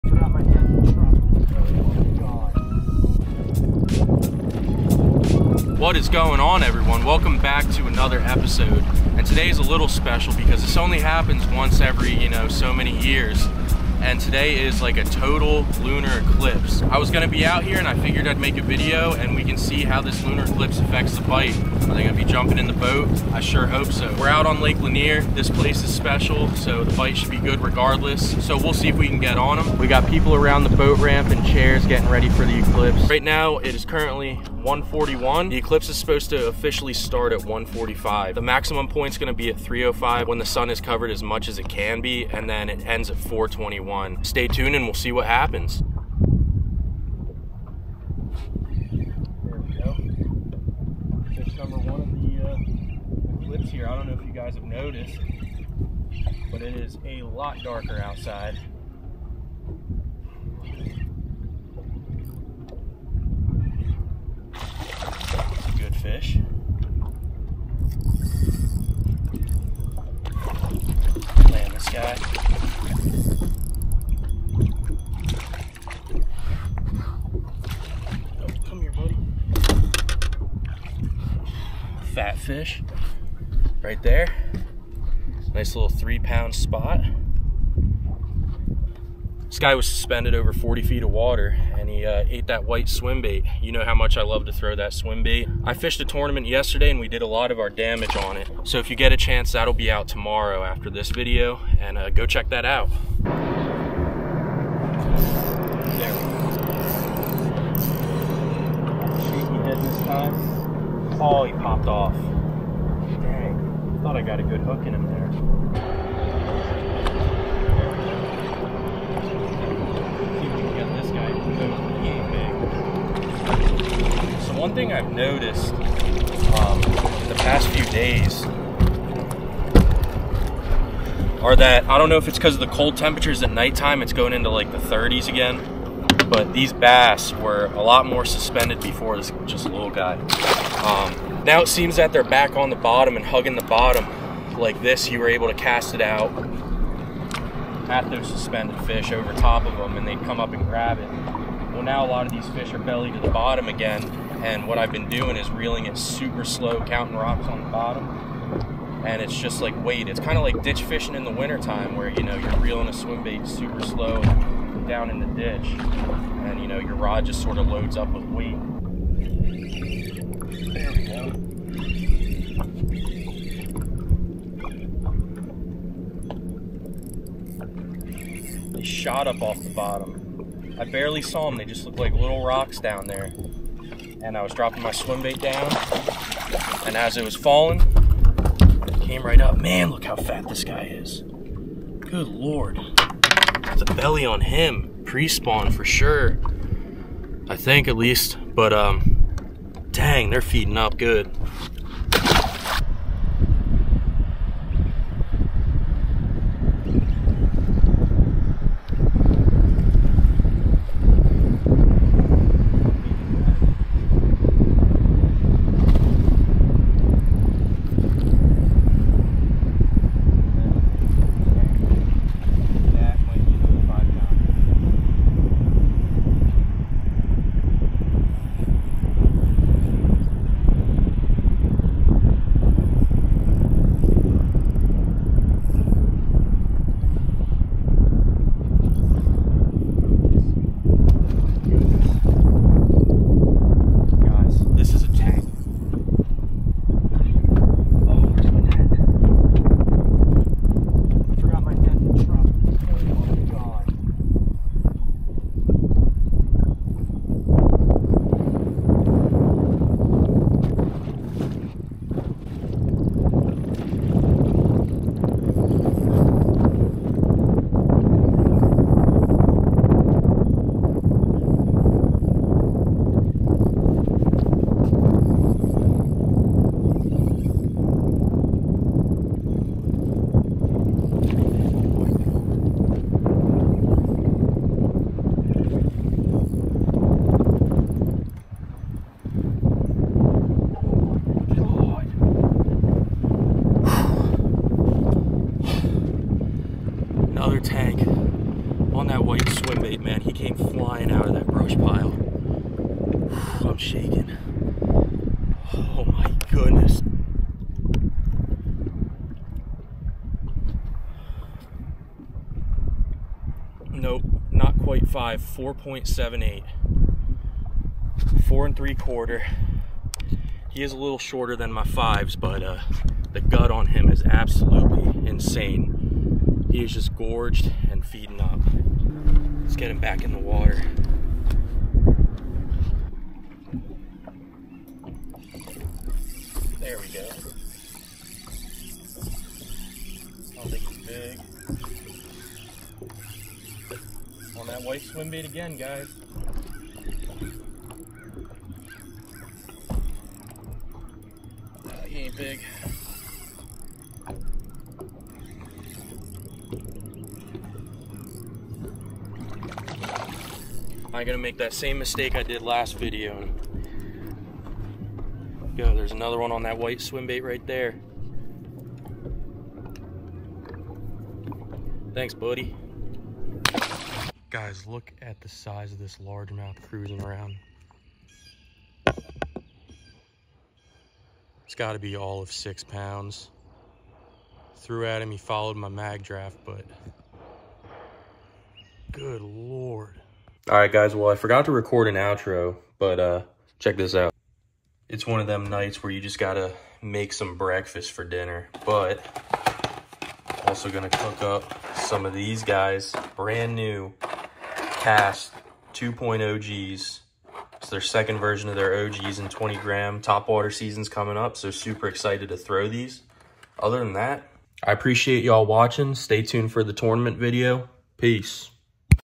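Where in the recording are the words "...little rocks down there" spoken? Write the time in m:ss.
3:02.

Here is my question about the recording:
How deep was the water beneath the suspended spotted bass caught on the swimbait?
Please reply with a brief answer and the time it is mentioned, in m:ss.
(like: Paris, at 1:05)
40 feet, at 1:30.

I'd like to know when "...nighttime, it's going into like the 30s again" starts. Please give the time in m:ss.
2:13.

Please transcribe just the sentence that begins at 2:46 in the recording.
And, you know, your rod just sort of loads up with weight.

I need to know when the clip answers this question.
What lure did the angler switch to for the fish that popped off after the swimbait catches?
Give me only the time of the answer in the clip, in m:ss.
1:49.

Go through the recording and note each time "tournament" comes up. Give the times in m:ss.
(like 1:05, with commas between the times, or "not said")
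1:36, 6:56.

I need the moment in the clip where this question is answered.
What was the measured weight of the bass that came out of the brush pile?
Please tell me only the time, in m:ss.
5:15.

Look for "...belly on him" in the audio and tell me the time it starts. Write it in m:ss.
3:13.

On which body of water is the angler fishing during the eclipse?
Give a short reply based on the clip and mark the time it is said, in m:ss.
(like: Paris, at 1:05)
Lake Lanier, at 0:24.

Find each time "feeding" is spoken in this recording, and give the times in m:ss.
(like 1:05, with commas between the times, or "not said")
3:20, 5:28.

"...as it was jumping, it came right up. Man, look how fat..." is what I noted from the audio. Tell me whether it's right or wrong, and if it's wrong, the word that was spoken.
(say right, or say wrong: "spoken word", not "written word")
wrong: "falling", not "jumping".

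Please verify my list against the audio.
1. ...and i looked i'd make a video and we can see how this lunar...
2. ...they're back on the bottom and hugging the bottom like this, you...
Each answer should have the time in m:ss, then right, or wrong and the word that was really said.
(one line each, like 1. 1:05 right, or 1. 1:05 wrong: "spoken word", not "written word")
1. 0:17 wrong: "figured", not "looked"
2. 2:22 right.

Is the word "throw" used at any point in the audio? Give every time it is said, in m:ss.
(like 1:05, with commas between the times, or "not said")
1:34, 6:52.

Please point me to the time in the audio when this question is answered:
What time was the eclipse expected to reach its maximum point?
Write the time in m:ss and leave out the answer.
0:39.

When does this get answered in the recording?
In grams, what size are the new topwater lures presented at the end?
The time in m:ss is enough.
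6:49.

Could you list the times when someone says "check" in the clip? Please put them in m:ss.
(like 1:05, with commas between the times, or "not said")
1:42, 6:33.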